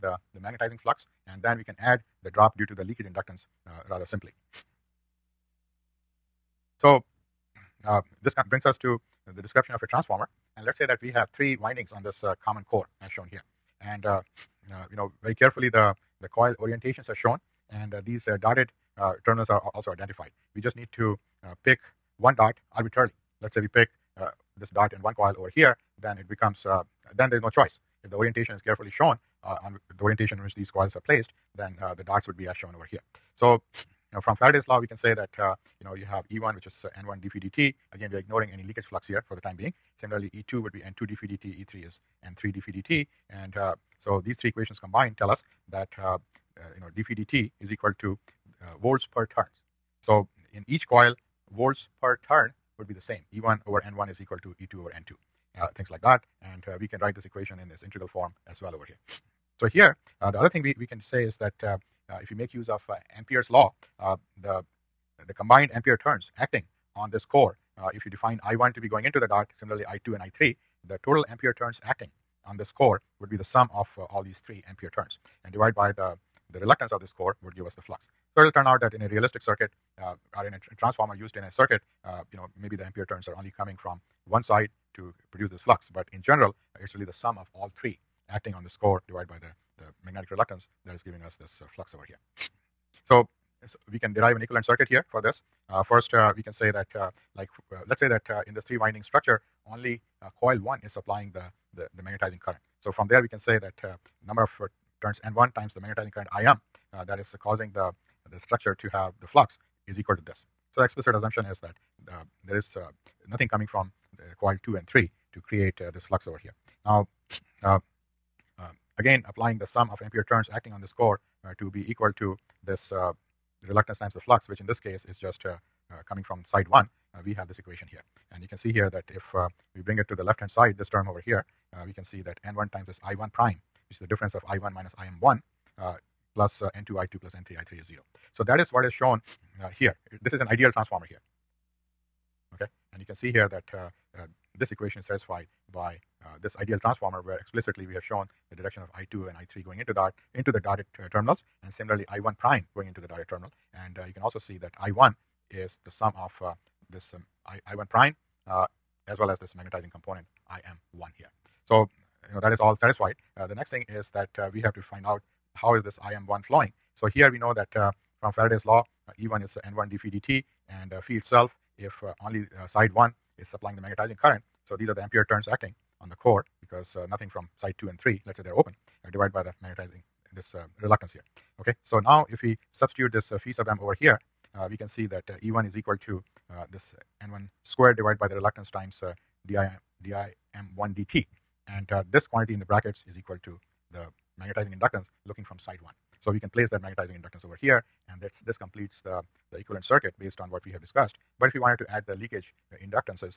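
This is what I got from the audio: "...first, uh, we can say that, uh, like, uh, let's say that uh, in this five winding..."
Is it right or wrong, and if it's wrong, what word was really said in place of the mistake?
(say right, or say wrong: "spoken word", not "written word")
wrong: "three", not "five".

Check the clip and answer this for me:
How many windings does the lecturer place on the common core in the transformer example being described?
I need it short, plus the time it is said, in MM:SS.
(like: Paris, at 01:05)
3, at 00:11.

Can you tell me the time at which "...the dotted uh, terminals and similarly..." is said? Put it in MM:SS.
02:30.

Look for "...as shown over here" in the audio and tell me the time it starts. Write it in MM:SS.
00:32.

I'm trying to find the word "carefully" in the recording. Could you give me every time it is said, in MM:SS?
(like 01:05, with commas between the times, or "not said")
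00:15, 00:28.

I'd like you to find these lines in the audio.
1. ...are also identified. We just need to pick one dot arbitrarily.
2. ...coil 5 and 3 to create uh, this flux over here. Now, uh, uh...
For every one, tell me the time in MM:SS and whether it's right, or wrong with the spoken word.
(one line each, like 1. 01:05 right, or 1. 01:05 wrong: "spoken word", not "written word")
1. 00:19 right
2. 01:54 wrong: "2", not "5".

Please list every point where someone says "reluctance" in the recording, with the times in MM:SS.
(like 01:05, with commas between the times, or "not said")
01:16, 01:30, 02:03, 03:00, 03:08.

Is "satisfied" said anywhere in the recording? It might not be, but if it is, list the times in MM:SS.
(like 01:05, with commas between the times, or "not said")
02:25, 02:42.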